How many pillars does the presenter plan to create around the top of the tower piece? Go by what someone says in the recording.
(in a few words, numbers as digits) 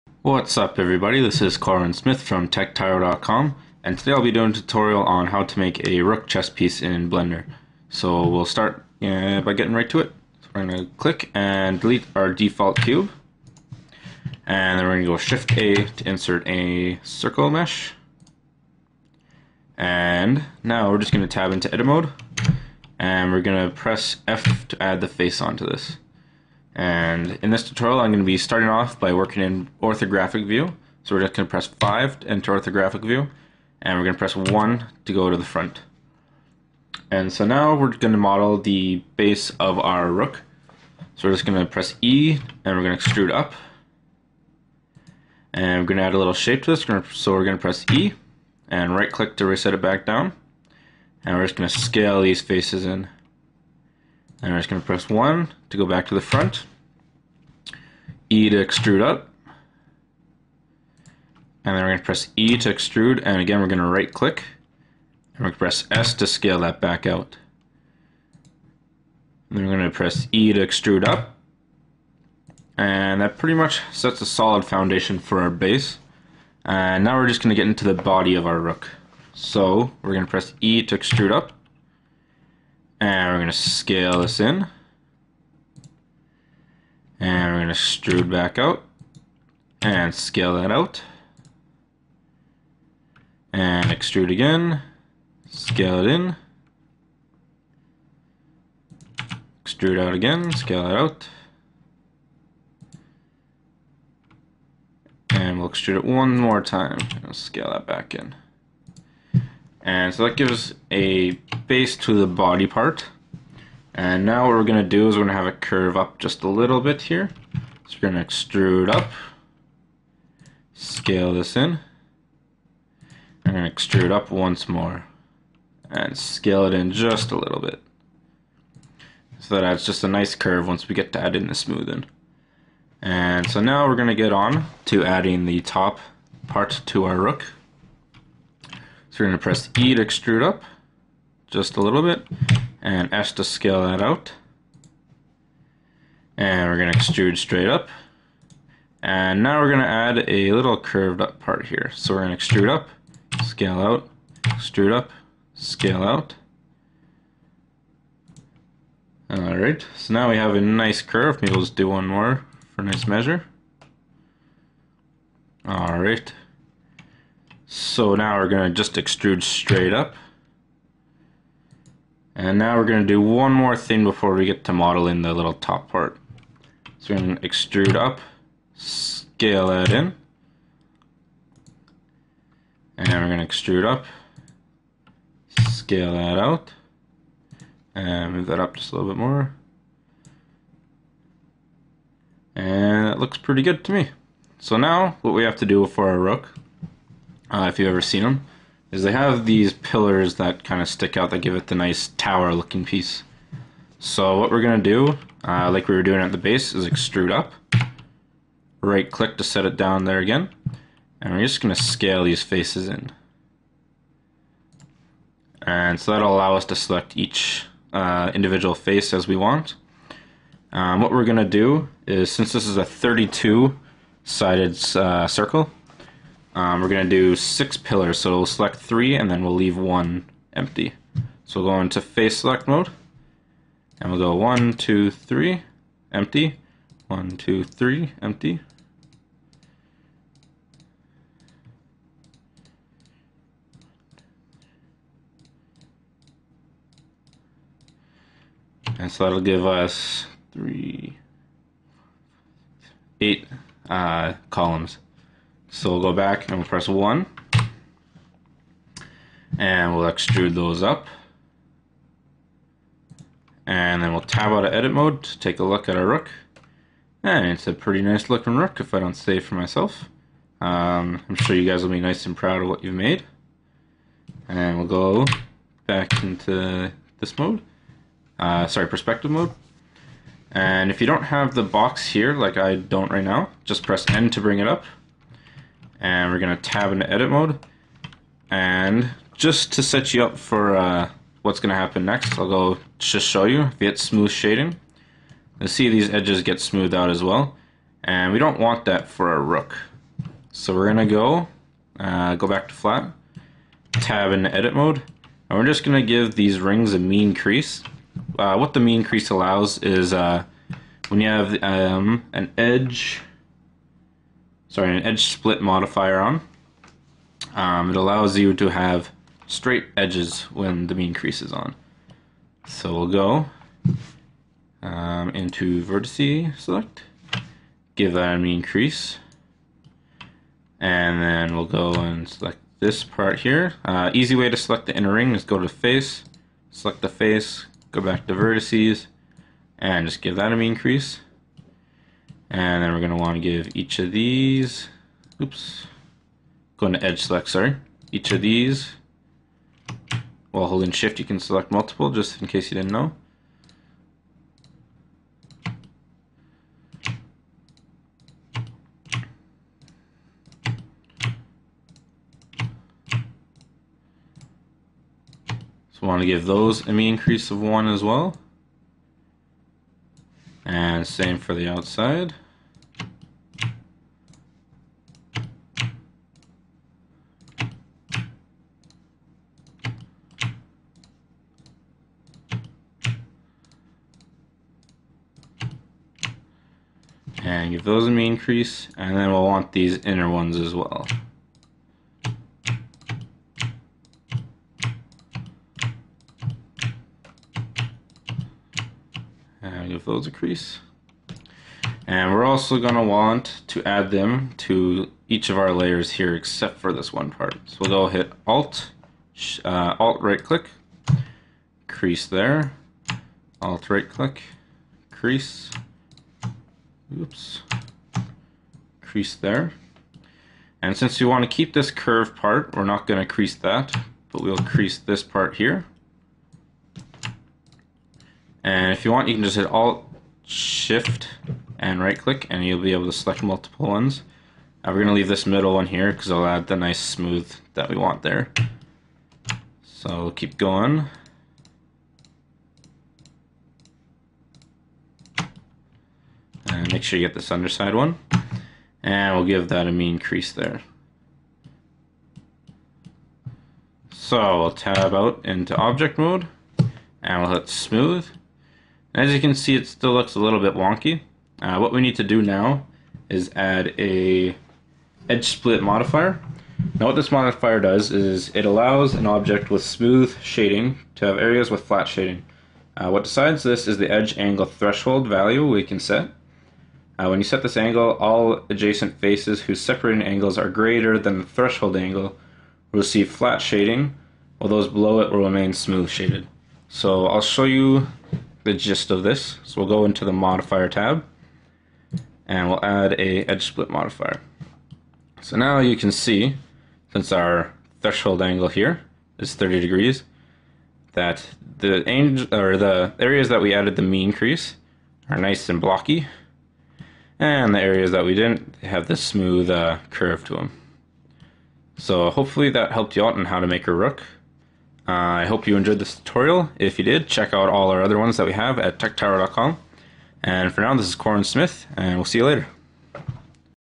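6.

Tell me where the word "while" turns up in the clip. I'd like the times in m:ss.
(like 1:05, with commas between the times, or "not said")
5:50, 8:04.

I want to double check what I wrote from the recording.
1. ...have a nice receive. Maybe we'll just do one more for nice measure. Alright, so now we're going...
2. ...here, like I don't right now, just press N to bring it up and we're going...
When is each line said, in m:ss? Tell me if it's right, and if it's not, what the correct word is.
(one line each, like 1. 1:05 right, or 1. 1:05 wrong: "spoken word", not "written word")
1. 2:40 wrong: "curve", not "receive"
2. 4:42 right.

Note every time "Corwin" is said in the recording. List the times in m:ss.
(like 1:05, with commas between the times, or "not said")
0:01, 8:41.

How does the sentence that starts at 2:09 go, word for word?
So that adds just a nice curve once we get to add in the smoothing.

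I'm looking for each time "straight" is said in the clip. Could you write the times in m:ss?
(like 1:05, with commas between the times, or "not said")
2:27, 2:49, 5:19.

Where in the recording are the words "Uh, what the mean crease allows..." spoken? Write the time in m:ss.
5:08.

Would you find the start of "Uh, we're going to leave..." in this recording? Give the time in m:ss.
7:14.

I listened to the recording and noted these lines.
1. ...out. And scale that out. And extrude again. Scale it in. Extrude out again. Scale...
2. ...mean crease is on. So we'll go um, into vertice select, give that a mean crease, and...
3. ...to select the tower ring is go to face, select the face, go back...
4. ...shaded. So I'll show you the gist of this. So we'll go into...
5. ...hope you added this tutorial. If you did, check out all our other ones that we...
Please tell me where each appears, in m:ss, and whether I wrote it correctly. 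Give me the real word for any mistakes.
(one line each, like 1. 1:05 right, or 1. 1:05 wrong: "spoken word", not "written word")
1. 1:28 right
2. 5:20 right
3. 5:34 wrong: "inner", not "tower"
4. 8:06 right
5. 8:35 wrong: "enjoyed", not "added".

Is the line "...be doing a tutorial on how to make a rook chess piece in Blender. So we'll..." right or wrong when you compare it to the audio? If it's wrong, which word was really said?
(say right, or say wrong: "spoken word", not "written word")
right.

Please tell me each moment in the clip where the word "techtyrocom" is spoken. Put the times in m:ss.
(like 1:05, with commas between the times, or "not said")
0:02, 8:38.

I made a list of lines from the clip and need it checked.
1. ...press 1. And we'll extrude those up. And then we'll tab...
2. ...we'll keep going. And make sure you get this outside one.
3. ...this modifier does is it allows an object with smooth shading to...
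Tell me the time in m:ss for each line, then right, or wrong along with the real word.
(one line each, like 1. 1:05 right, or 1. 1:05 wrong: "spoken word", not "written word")
1. 4:16 right
2. 7:20 wrong: "underside", not "outside"
3. 7:47 right.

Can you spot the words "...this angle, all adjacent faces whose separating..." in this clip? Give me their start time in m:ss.
7:57.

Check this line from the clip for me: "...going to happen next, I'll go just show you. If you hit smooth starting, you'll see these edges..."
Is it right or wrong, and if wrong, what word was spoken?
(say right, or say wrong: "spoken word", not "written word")
wrong: "shading", not "starting".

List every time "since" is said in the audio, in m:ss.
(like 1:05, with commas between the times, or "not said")
3:42, 7:00, 8:17.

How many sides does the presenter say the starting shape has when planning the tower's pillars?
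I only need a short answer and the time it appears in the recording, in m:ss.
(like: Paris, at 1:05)
32, at 3:42.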